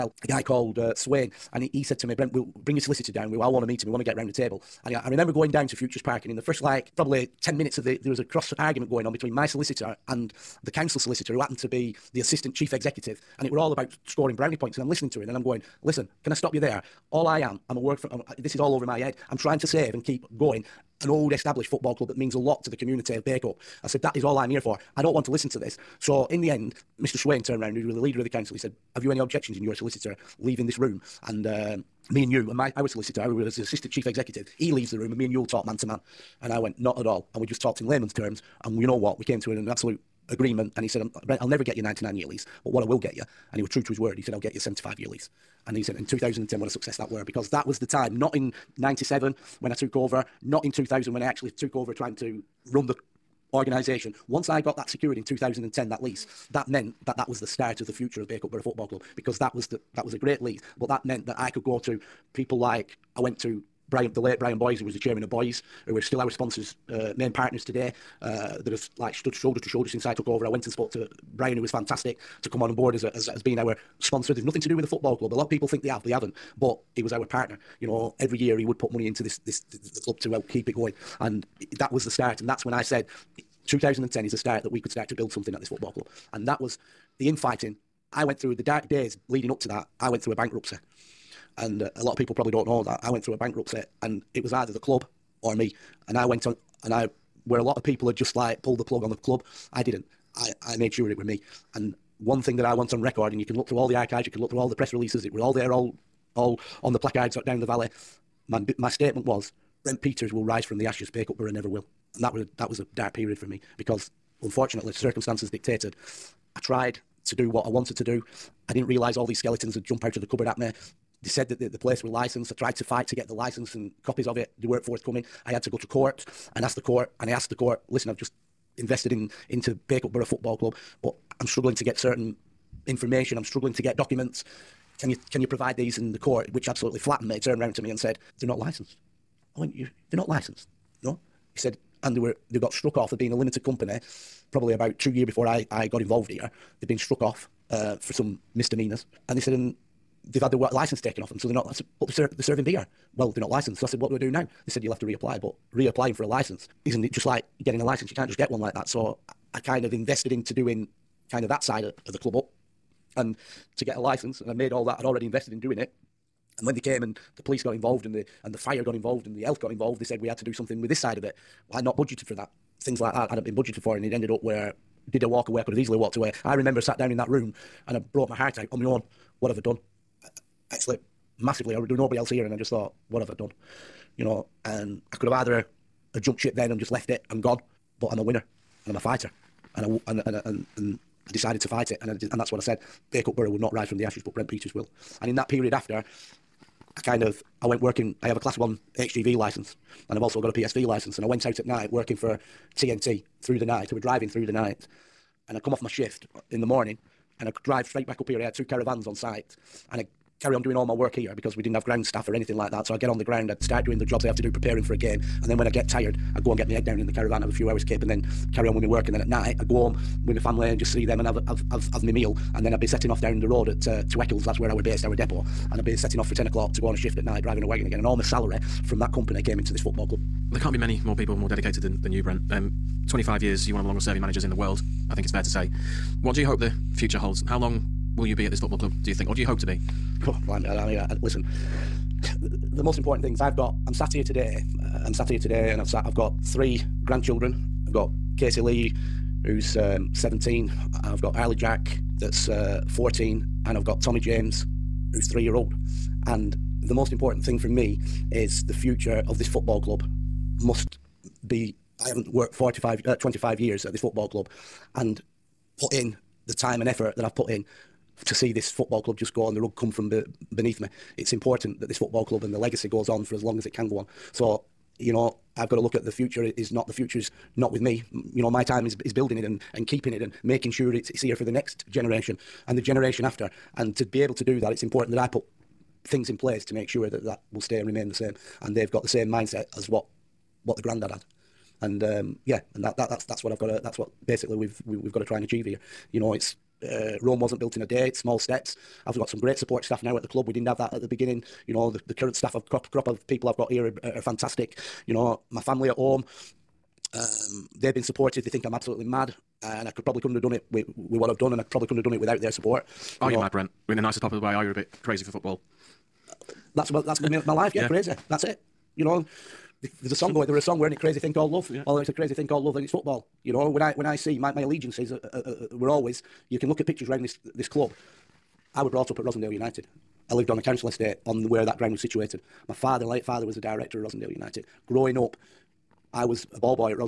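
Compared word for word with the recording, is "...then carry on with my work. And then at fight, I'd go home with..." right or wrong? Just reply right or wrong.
wrong.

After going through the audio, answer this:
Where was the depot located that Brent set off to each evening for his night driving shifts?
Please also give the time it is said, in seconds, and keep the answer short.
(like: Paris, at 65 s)
Eccles, at 224 s.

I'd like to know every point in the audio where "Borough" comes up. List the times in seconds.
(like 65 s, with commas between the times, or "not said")
58 s, 111 s, 130 s, 193 s.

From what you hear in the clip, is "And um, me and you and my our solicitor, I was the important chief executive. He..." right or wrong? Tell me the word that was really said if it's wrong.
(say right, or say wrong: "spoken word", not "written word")
wrong: "assistant", not "important".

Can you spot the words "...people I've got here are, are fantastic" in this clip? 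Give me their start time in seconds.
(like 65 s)
303 s.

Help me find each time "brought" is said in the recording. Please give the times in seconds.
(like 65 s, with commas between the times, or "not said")
177 s, 328 s.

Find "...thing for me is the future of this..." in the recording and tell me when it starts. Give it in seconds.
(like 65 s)
257 s.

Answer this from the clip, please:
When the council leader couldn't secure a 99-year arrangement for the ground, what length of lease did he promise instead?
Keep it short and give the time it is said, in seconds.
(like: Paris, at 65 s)
75 years, at 44 s.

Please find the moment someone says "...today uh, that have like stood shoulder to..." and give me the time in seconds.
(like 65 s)
67 s.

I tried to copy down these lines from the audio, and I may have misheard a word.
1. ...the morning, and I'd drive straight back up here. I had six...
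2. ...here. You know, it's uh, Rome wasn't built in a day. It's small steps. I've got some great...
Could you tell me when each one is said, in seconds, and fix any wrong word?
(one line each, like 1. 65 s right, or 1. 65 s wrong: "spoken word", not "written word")
1. 206 s wrong: "two", not "six"
2. 295 s right.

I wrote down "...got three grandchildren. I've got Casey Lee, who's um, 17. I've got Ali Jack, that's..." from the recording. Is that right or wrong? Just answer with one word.
right.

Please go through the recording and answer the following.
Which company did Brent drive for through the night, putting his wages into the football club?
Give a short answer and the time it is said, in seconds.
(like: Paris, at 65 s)
TNT, at 202 s.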